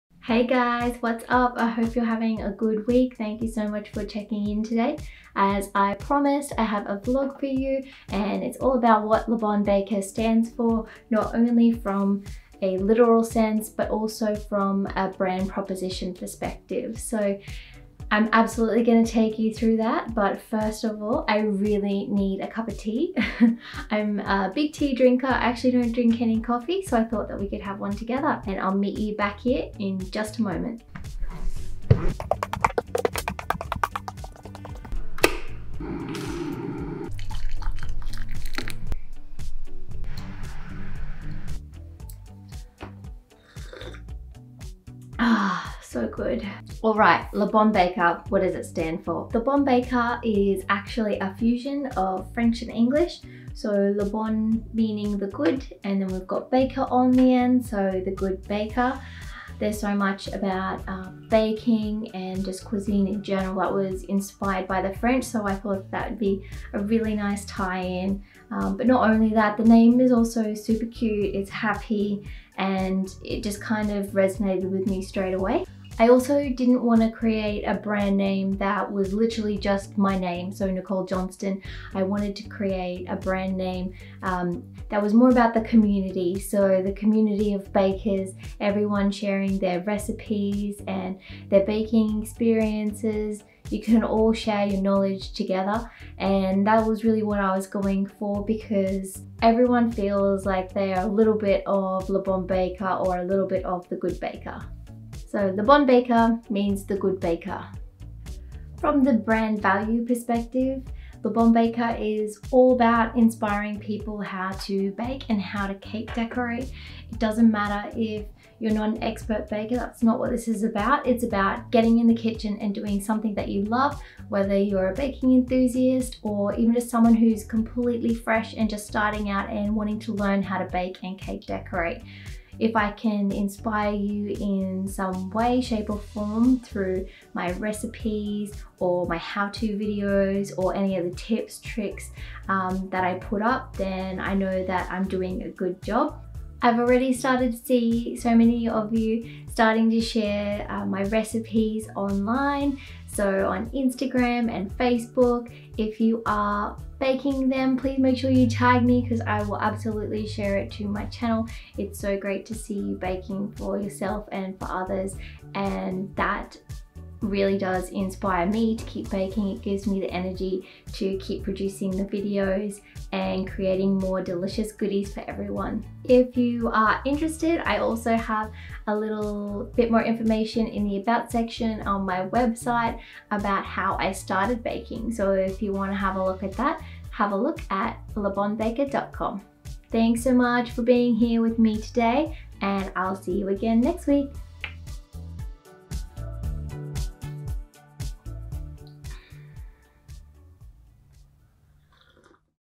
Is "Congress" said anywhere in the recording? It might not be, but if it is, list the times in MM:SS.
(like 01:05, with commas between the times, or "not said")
not said.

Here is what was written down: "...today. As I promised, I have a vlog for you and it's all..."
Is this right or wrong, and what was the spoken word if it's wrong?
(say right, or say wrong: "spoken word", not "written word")
right.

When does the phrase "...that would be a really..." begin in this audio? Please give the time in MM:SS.
01:05.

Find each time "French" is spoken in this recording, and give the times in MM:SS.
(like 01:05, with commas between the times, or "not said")
00:52, 01:04.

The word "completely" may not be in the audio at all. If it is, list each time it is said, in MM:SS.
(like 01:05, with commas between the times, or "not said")
02:07.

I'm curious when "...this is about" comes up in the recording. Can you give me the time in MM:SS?
02:00.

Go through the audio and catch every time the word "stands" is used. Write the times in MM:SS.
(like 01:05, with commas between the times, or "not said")
00:10, 00:48.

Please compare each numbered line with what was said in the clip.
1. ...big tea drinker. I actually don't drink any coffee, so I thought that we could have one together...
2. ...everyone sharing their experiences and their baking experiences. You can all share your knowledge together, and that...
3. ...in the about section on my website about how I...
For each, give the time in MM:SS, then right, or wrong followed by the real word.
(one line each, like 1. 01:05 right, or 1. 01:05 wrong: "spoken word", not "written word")
1. 00:24 right
2. 01:28 wrong: "recipes", not "experiences"
3. 03:00 right.